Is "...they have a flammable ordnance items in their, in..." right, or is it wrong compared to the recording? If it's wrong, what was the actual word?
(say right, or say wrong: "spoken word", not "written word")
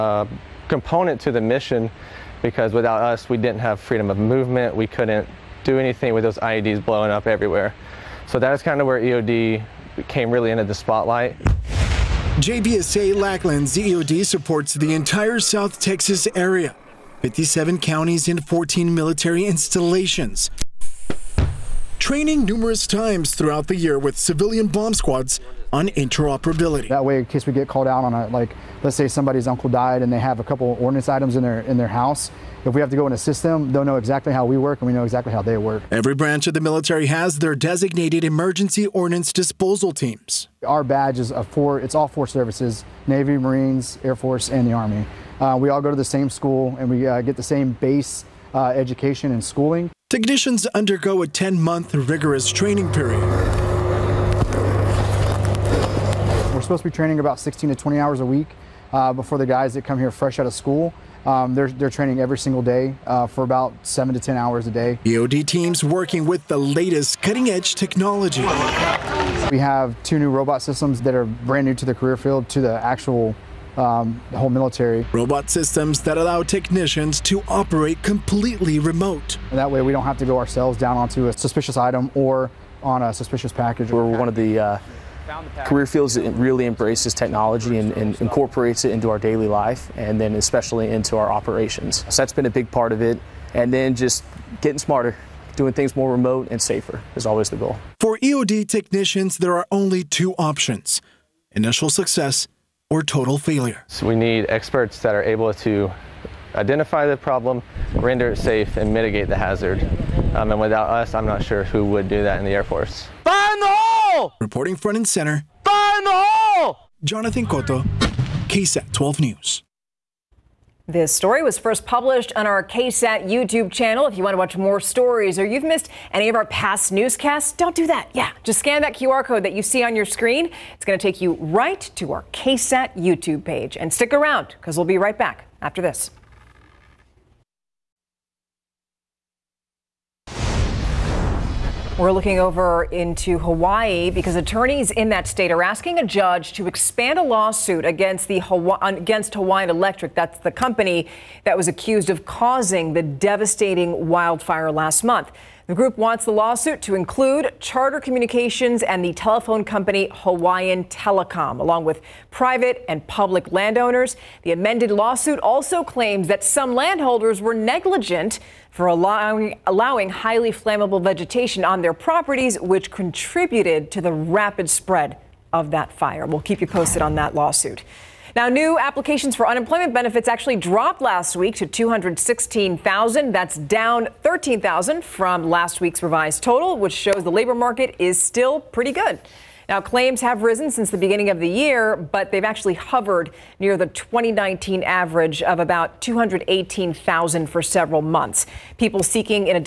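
wrong: "couple", not "flammable".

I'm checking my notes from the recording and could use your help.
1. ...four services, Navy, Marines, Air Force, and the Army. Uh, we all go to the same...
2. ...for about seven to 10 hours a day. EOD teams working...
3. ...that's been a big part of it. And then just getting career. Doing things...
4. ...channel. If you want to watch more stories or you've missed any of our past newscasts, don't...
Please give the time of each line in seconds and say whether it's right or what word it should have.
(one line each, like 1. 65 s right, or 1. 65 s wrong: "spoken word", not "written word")
1. 42 s right
2. 63 s right
3. 92 s wrong: "smarter", not "career"
4. 123 s right.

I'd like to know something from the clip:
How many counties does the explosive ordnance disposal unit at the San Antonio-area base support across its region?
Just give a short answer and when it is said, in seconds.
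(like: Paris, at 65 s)
57, at 17 s.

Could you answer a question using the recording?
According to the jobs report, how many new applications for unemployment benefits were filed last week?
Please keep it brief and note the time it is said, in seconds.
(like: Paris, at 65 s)
216,000, at 181 s.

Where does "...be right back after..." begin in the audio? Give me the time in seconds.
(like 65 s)
134 s.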